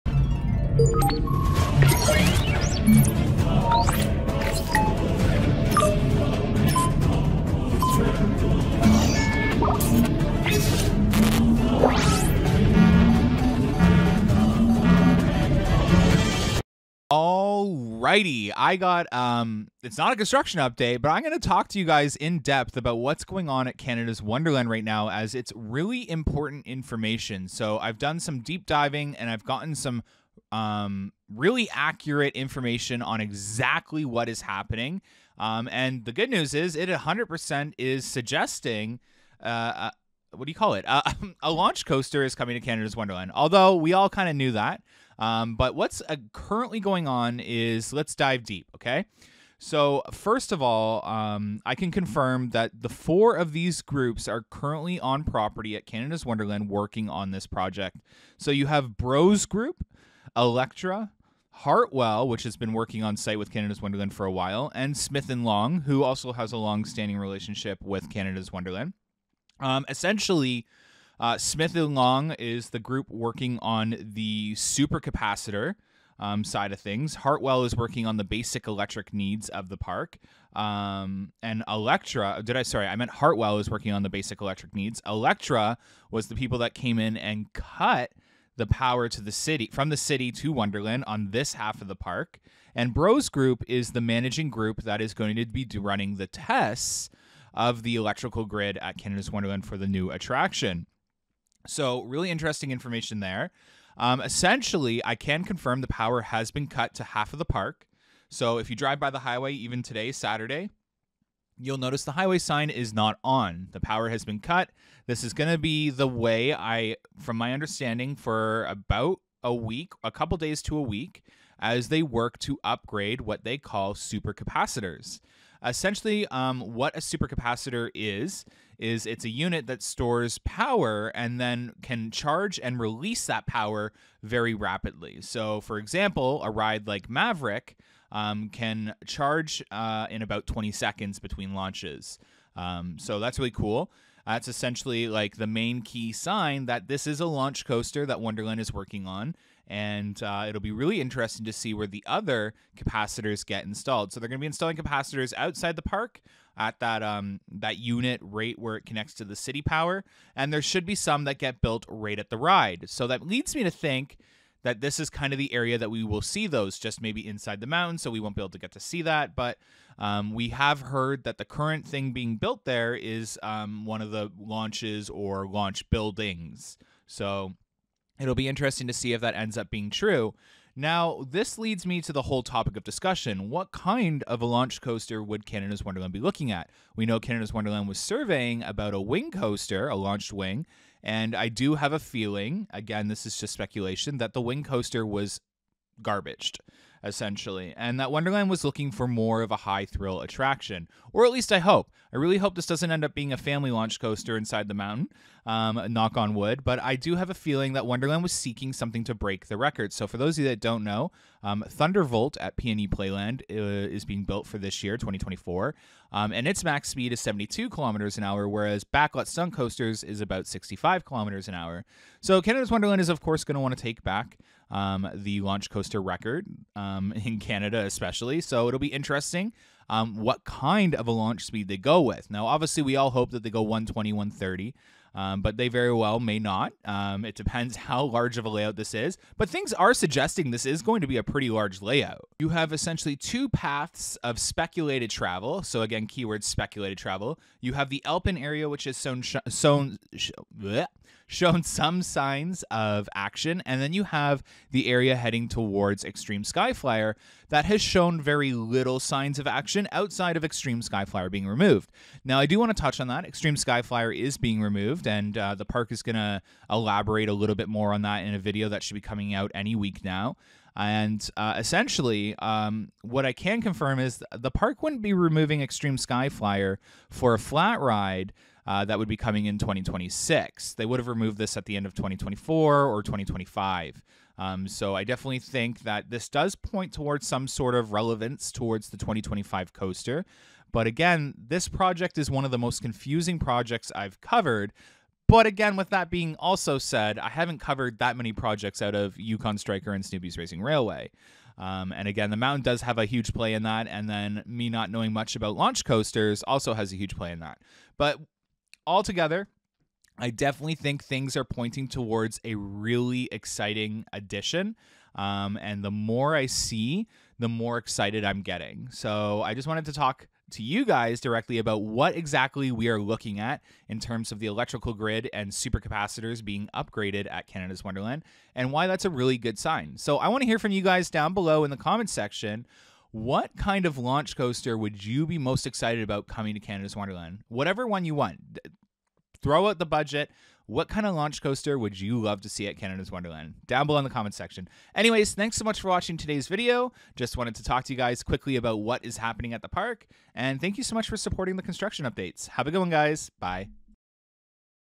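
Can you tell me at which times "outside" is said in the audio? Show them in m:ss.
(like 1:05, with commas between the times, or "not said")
2:35, 4:19.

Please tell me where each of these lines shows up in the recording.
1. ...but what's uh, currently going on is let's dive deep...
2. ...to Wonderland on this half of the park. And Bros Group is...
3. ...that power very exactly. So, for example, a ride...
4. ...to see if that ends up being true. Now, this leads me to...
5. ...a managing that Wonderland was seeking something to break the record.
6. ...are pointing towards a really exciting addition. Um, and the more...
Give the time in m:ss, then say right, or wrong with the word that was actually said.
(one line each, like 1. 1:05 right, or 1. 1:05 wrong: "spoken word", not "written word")
1. 0:45 right
2. 1:30 right
3. 2:13 wrong: "rapidly", not "exactly"
4. 2:58 right
5. 3:27 wrong: "feeling", not "managing"
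6. 5:11 right.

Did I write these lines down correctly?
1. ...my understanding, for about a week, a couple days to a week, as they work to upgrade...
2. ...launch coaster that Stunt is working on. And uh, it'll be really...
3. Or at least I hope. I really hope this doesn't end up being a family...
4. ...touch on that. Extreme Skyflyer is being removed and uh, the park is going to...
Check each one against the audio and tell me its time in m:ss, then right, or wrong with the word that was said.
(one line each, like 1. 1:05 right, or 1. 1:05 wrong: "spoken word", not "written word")
1. 1:57 right
2. 2:27 wrong: "Wonderland", not "Stunt"
3. 3:21 right
4. 4:22 right.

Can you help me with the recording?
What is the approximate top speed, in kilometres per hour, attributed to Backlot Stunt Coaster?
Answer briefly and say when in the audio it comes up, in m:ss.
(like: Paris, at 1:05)
65, at 3:40.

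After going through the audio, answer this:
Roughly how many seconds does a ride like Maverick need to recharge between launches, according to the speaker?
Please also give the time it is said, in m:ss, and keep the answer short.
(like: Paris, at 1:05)
20 seconds, at 2:20.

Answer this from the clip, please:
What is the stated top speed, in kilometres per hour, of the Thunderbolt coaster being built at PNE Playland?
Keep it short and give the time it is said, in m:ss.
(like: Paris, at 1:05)
72, at 3:37.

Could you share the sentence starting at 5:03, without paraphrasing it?
And then me not knowing much about launch coasters also has a huge play in that.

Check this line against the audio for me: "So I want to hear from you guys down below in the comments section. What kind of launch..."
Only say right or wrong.
right.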